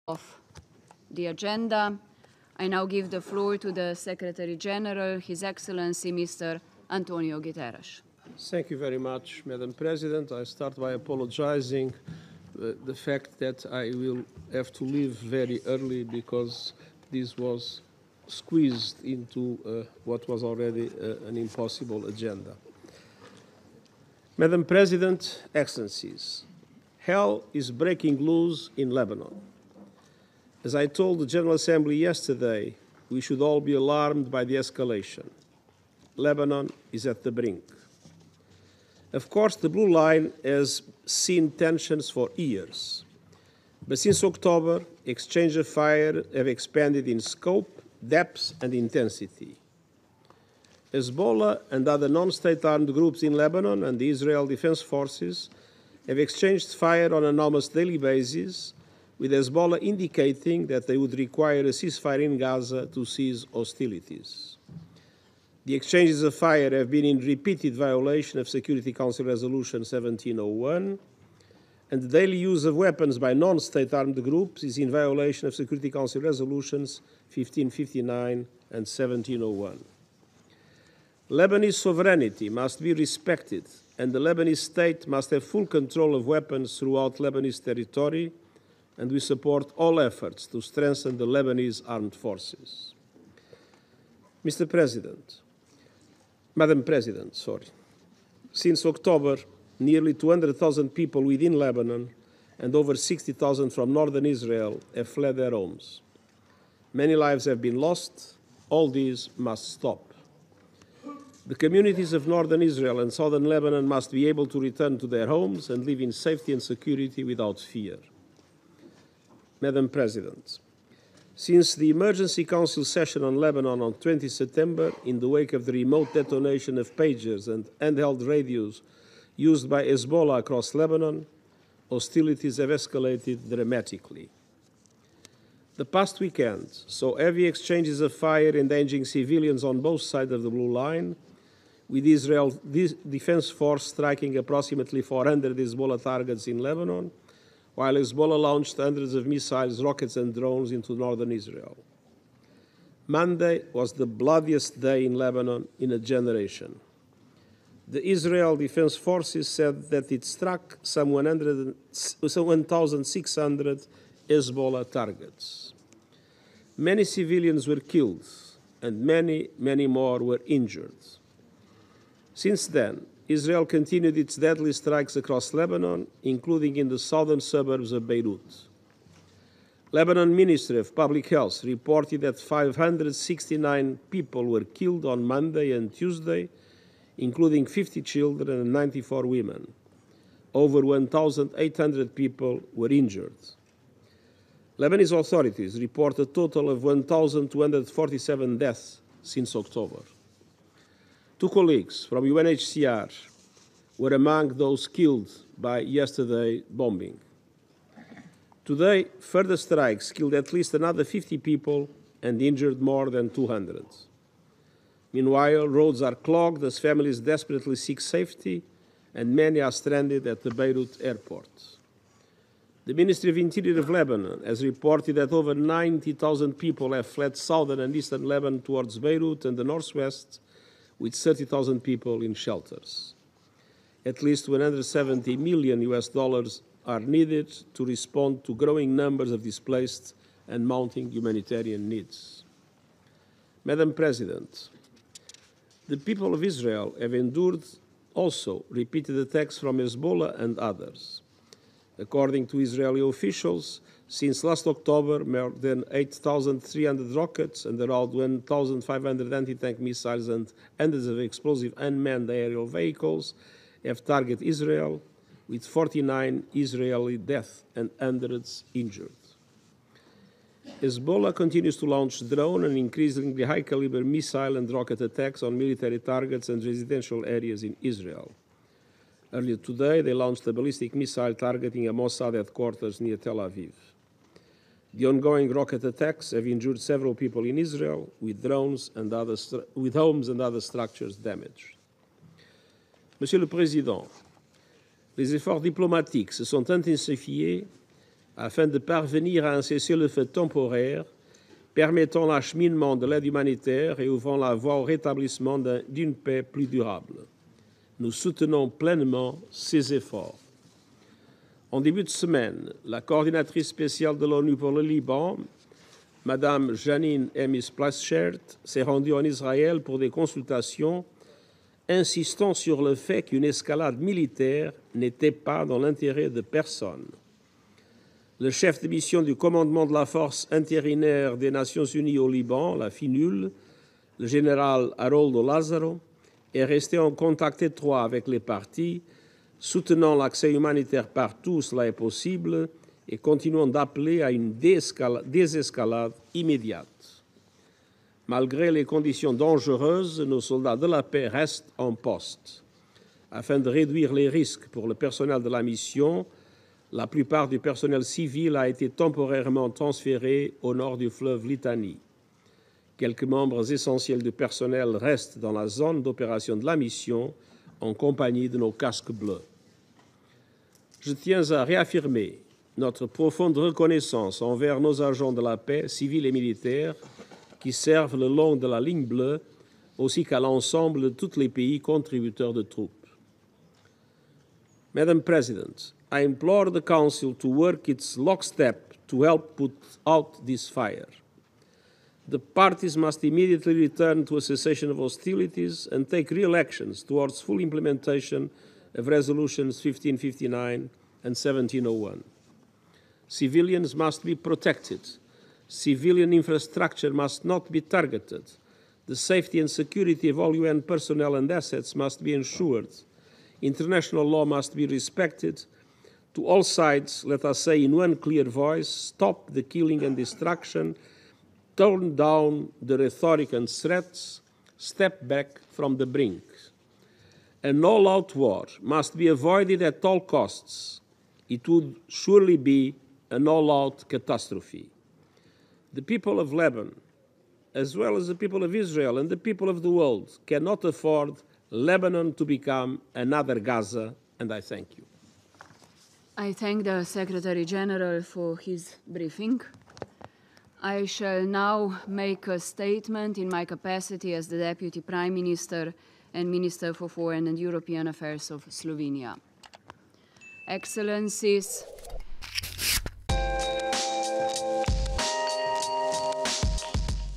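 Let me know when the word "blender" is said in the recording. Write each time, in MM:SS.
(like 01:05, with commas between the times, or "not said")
not said.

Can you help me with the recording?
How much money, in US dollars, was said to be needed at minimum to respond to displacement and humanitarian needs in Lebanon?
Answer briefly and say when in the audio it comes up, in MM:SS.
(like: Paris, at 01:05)
170 million US dollars, at 03:54.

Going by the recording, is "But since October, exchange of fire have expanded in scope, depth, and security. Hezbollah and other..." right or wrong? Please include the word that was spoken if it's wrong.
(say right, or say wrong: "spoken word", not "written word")
wrong: "intensity", not "security".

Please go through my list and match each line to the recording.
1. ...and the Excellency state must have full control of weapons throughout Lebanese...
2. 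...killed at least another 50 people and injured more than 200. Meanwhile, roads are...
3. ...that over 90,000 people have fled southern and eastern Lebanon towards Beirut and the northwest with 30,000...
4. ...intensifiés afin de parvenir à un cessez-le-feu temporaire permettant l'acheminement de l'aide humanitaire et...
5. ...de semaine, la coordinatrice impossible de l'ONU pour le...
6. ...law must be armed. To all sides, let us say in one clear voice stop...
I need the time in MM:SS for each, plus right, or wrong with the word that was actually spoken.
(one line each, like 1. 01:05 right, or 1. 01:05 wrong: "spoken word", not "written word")
1. 01:23 wrong: "Lebanese", not "Excellency"
2. 03:30 right
3. 03:45 right
4. 04:56 right
5. 05:12 wrong: "spéciale", not "impossible"
6. 06:54 wrong: "respected", not "armed".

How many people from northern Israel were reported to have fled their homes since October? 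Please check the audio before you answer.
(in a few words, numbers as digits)
over 60,000.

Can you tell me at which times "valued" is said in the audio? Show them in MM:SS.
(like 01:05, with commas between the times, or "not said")
not said.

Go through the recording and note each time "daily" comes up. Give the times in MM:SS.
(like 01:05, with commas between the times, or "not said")
00:57, 01:12.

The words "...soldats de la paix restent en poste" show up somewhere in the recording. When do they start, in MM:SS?
05:50.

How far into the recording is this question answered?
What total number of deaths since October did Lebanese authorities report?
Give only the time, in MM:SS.
03:16.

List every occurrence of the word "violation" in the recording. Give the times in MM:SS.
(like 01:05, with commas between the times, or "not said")
01:07, 01:14.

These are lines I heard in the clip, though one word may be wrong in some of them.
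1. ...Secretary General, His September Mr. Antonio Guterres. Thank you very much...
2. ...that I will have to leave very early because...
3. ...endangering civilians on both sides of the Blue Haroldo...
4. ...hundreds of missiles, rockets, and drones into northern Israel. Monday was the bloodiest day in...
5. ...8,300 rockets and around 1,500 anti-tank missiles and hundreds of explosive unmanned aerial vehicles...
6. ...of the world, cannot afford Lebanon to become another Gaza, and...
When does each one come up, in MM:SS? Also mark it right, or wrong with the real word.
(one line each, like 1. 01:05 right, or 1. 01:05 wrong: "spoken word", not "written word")
1. 00:03 wrong: "Excellency", not "September"
2. 00:13 right
3. 02:18 wrong: "Line", not "Haroldo"
4. 02:28 right
5. 04:15 right
6. 07:19 right.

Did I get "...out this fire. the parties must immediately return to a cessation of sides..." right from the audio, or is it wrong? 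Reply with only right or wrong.
wrong.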